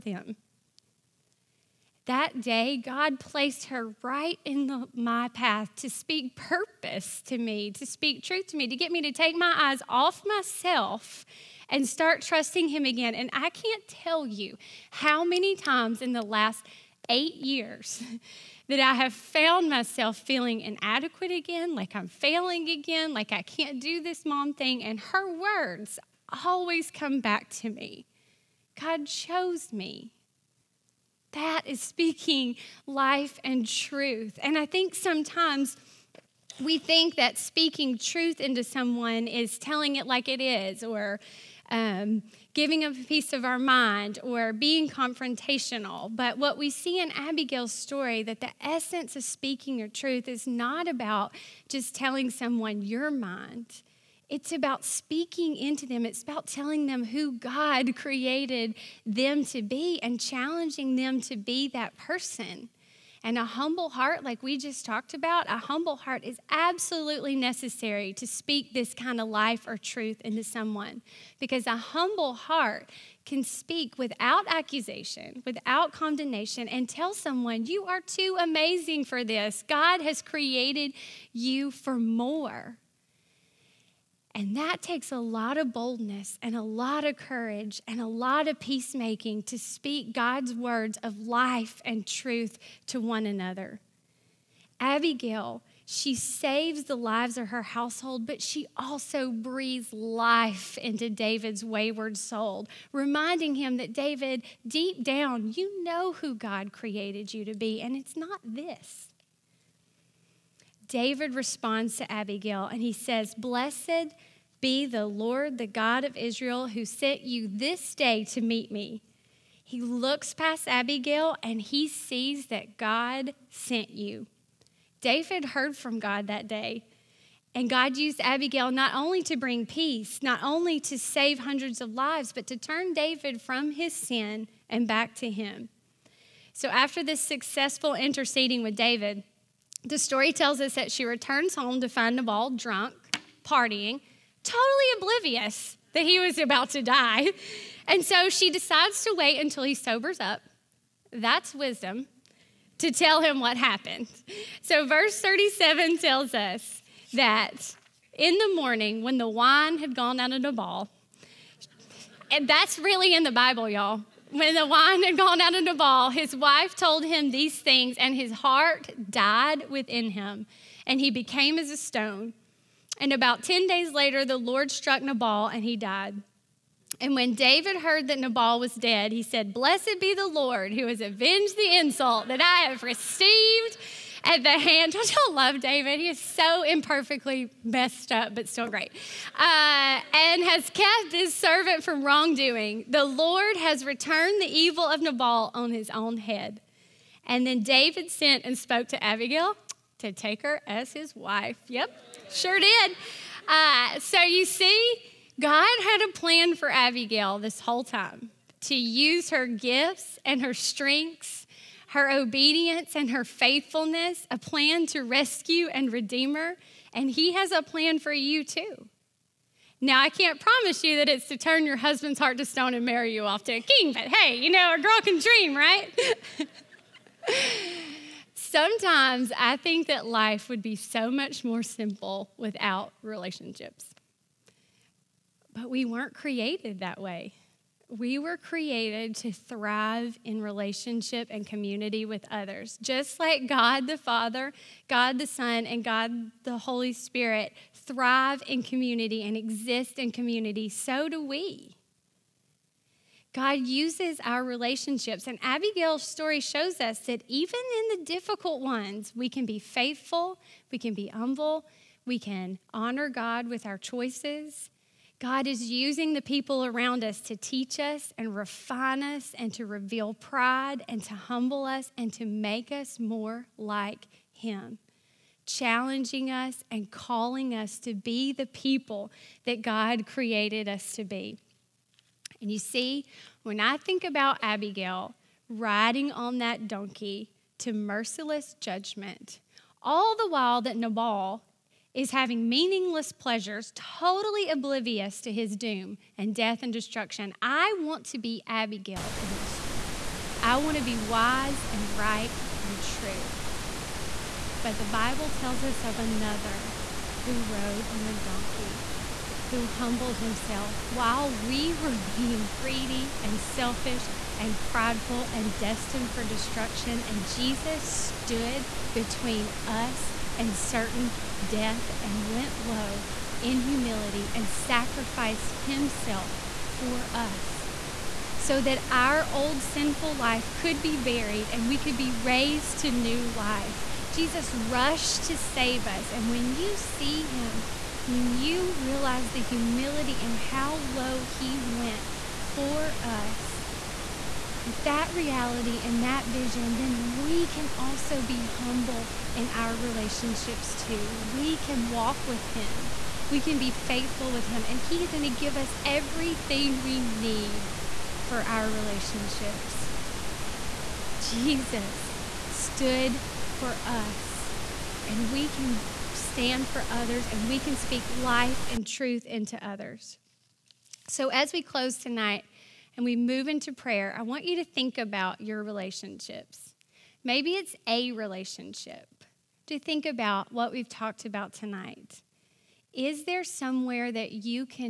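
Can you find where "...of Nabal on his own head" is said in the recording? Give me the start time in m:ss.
3:14.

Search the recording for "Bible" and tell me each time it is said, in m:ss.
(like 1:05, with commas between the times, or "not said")
2:43, 5:04.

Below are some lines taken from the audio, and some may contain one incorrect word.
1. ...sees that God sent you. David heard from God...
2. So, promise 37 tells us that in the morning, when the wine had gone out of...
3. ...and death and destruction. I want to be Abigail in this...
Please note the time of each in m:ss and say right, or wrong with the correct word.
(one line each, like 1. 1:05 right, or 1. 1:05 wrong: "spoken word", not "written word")
1. 2:01 right
2. 2:34 wrong: "verse", not "promise"
3. 4:56 right.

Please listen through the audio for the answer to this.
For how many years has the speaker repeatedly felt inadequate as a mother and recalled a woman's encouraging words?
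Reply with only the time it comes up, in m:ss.
0:17.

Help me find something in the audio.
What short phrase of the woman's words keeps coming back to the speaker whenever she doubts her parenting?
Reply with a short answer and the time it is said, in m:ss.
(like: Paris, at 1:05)
God chose me, at 0:28.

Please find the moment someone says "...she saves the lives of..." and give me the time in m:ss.
1:35.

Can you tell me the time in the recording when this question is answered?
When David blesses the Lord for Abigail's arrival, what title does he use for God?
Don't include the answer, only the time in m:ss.
1:55.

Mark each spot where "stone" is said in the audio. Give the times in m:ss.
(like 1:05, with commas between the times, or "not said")
2:51, 3:42.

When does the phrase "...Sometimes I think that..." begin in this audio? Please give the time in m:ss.
3:48.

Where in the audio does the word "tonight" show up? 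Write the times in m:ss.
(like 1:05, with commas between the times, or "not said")
6:11, 6:21.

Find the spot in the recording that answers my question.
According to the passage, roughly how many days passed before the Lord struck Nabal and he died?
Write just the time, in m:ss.
2:53.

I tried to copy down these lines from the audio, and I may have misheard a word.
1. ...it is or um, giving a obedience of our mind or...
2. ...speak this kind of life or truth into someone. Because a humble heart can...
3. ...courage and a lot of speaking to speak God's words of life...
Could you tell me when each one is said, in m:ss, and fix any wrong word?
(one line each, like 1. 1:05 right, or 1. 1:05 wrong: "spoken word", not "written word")
1. 0:40 wrong: "piece", not "obedience"
2. 1:08 right
3. 1:27 wrong: "peacemaking", not "speaking".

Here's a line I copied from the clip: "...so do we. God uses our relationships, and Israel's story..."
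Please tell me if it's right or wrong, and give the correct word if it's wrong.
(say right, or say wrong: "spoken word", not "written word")
wrong: "Abigail", not "Israel".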